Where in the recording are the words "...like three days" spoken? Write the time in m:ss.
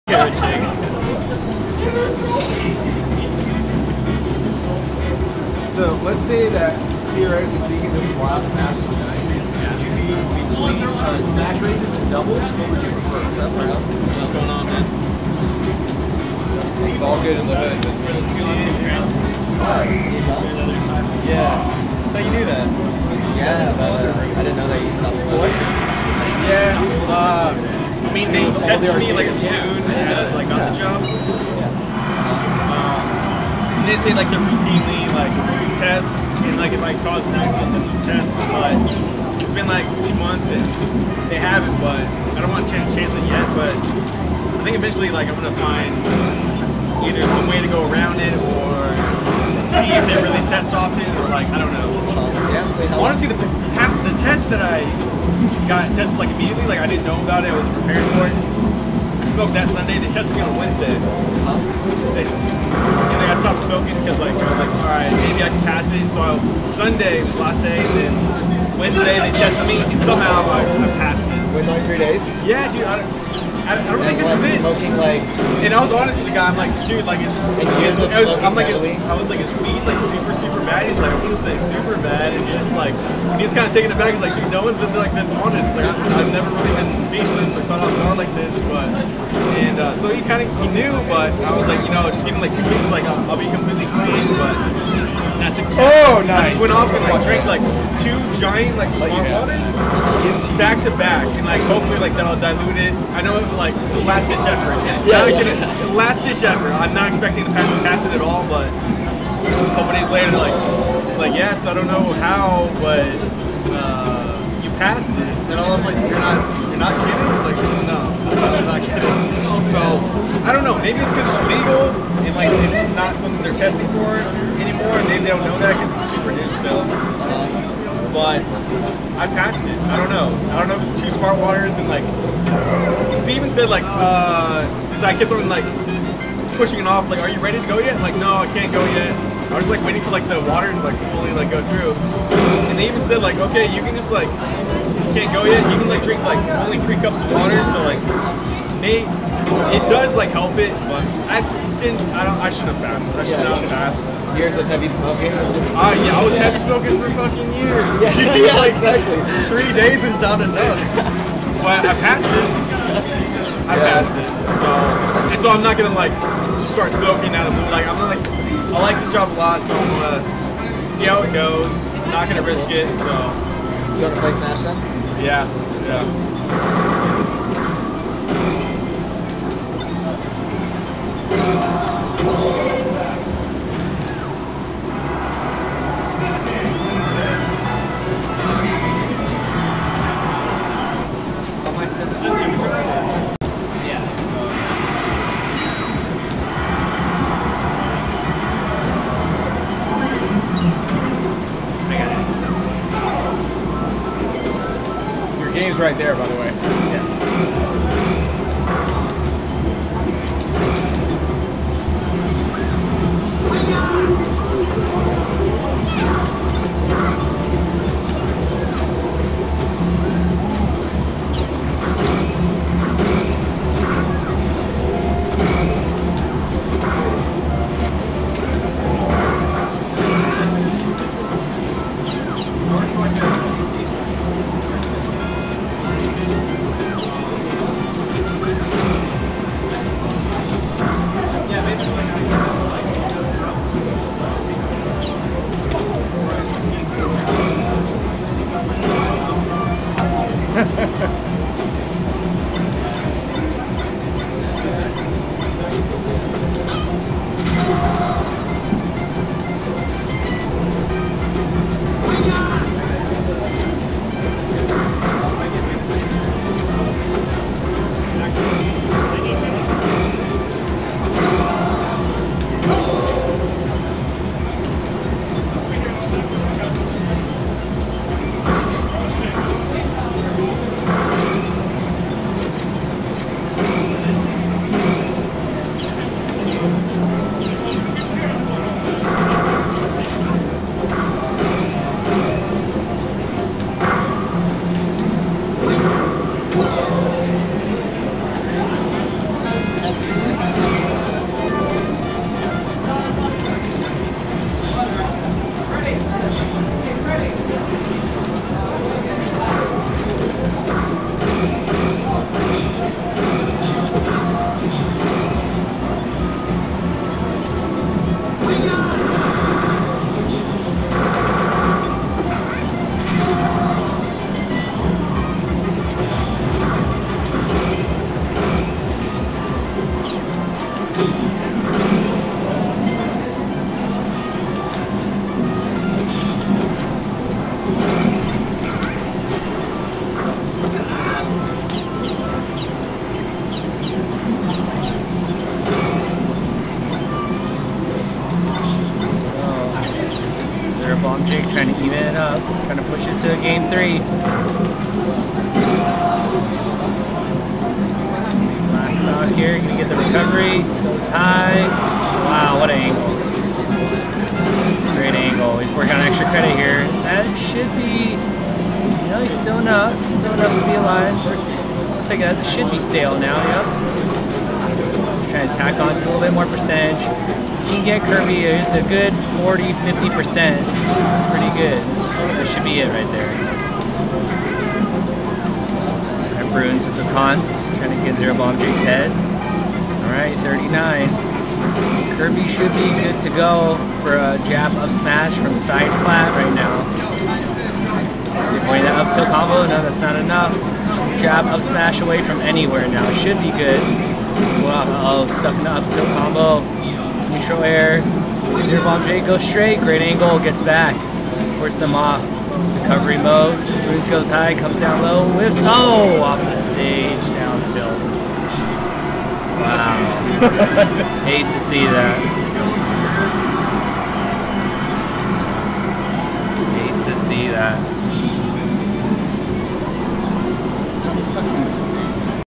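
1:11.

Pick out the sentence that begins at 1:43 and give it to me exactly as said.
I know like it's the last ditch effort.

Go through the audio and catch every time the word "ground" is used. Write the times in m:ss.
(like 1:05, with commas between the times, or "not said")
0:18.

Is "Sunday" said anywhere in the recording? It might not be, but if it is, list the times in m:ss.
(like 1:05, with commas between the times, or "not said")
0:59, 1:06.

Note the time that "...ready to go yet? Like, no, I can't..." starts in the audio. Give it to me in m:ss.
2:17.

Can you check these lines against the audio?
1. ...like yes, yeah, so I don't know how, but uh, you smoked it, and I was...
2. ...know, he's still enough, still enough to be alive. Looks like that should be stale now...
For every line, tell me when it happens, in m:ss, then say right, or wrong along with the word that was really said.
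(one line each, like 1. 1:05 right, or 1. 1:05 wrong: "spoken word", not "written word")
1. 1:51 wrong: "passed", not "smoked"
2. 6:09 right.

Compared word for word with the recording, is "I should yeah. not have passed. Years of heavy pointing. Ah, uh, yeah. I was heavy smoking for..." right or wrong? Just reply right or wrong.
wrong.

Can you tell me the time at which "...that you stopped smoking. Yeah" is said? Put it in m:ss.
0:24.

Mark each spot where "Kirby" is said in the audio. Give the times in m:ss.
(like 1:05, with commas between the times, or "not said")
6:18, 6:32.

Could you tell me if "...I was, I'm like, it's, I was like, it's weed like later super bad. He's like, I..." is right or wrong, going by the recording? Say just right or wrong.
wrong.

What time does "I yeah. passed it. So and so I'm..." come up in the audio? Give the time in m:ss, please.
2:43.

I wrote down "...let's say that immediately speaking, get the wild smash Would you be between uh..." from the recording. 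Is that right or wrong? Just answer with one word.
wrong.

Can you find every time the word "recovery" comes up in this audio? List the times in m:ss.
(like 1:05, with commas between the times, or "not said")
5:59, 6:52.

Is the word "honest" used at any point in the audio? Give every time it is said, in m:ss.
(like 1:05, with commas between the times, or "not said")
1:15, 1:25.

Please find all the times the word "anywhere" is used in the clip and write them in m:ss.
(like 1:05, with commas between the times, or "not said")
6:42.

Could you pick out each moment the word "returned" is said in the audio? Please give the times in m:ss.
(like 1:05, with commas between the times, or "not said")
not said.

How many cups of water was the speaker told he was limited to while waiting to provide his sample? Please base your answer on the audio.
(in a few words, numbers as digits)
3.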